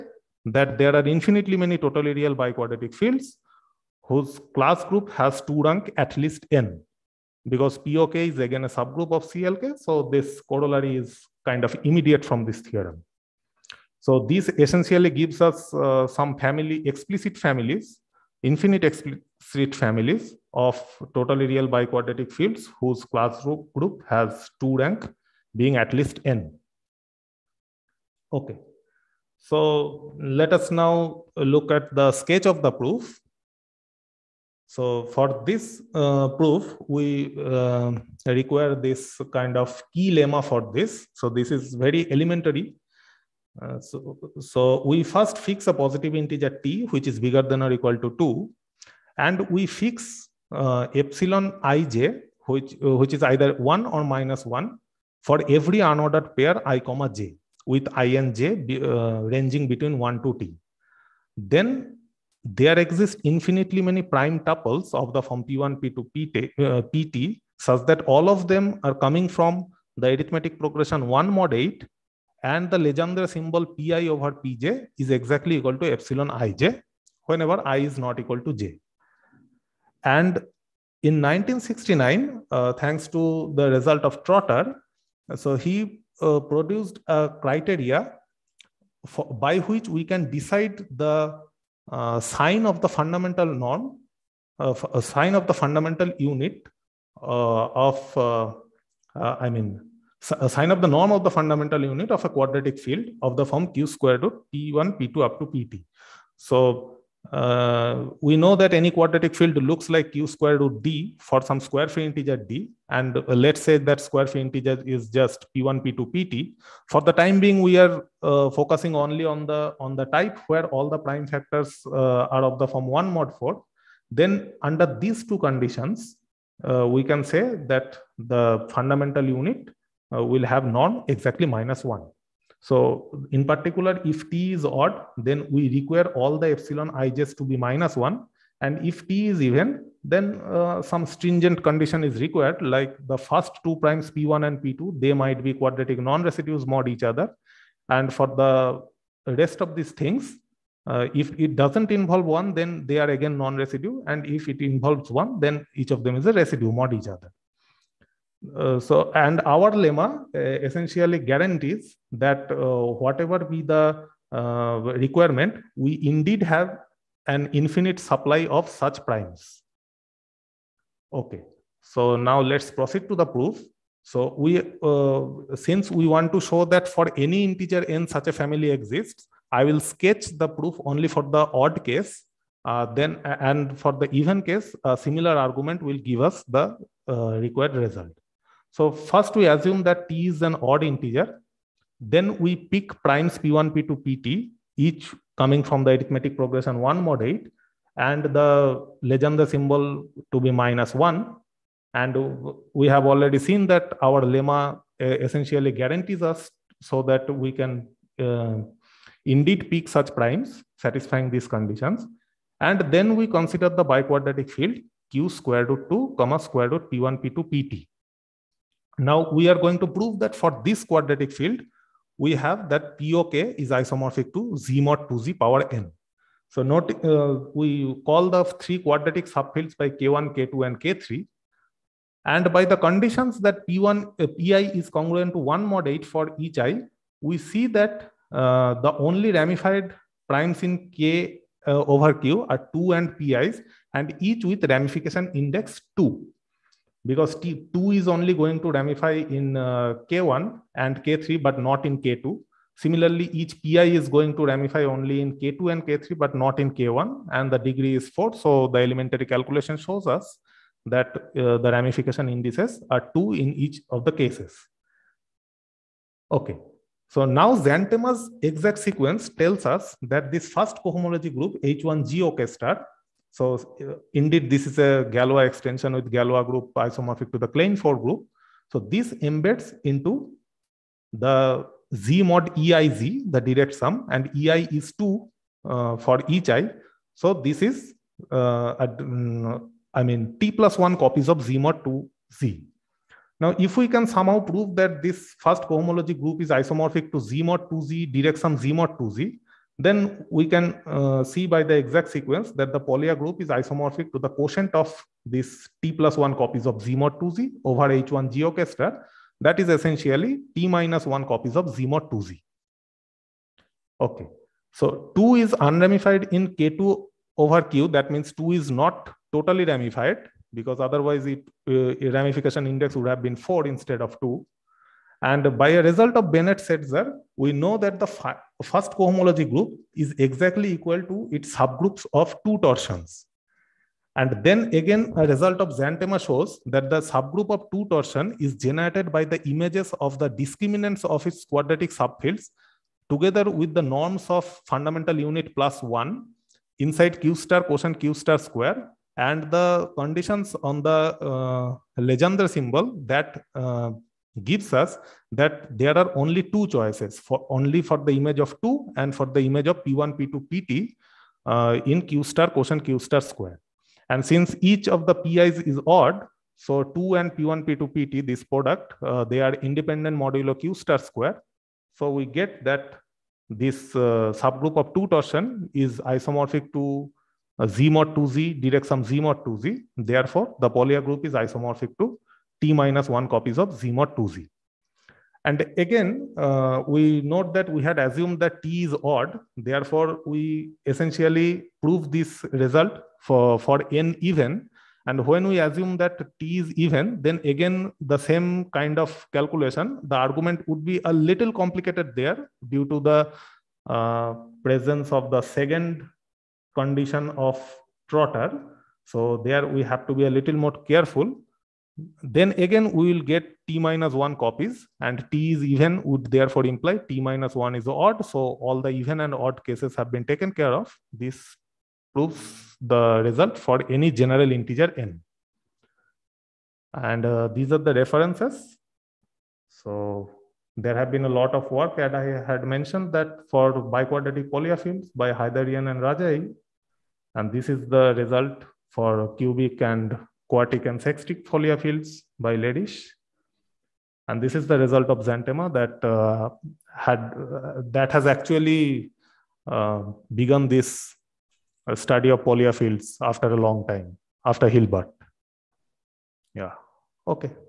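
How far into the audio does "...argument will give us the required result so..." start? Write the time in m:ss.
3:05.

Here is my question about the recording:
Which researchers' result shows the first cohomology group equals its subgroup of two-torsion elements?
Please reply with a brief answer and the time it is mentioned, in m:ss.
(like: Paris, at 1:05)
Bennett-Setzer, at 5:26.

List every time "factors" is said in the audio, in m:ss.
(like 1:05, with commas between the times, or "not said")
2:01.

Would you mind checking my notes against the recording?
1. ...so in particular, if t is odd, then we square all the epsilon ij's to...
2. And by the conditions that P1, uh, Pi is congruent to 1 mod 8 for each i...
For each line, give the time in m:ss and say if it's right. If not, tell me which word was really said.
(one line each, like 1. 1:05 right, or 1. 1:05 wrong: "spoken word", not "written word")
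1. 2:12 wrong: "require", not "square"
2. 3:52 right.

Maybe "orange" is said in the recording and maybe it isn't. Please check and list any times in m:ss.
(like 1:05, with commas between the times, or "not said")
not said.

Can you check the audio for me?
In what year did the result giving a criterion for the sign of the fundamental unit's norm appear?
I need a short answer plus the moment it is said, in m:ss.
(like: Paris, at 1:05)
1969, at 1:21.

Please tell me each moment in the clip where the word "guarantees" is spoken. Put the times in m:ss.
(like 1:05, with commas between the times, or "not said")
2:41, 3:25.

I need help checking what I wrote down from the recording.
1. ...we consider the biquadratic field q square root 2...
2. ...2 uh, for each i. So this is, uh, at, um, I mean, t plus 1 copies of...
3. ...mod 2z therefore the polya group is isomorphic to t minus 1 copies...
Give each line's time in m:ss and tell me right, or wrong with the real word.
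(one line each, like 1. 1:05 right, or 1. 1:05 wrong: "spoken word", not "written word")
1. 3:33 right
2. 4:44 right
3. 6:19 right.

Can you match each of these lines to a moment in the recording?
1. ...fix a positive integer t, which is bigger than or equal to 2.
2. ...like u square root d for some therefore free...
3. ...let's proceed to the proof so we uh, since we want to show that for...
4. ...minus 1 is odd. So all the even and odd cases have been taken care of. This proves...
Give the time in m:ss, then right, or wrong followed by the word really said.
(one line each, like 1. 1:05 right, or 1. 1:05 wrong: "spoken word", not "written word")
1. 0:45 right
2. 1:49 wrong: "square", not "therefore"
3. 2:52 right
4. 6:57 right.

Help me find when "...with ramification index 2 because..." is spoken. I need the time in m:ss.
4:04.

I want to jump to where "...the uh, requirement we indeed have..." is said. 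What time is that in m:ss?
2:43.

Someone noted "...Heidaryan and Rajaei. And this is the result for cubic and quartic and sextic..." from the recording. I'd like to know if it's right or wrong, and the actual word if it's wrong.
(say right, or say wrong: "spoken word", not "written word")
right.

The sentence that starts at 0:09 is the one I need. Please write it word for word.
So this corollary is kind of immediate from this theorem.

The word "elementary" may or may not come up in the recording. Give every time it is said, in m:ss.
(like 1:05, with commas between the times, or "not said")
0:42, 4:18.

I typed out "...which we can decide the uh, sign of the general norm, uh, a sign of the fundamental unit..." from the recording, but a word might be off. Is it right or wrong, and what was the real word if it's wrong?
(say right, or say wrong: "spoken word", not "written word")
wrong: "fundamental", not "general".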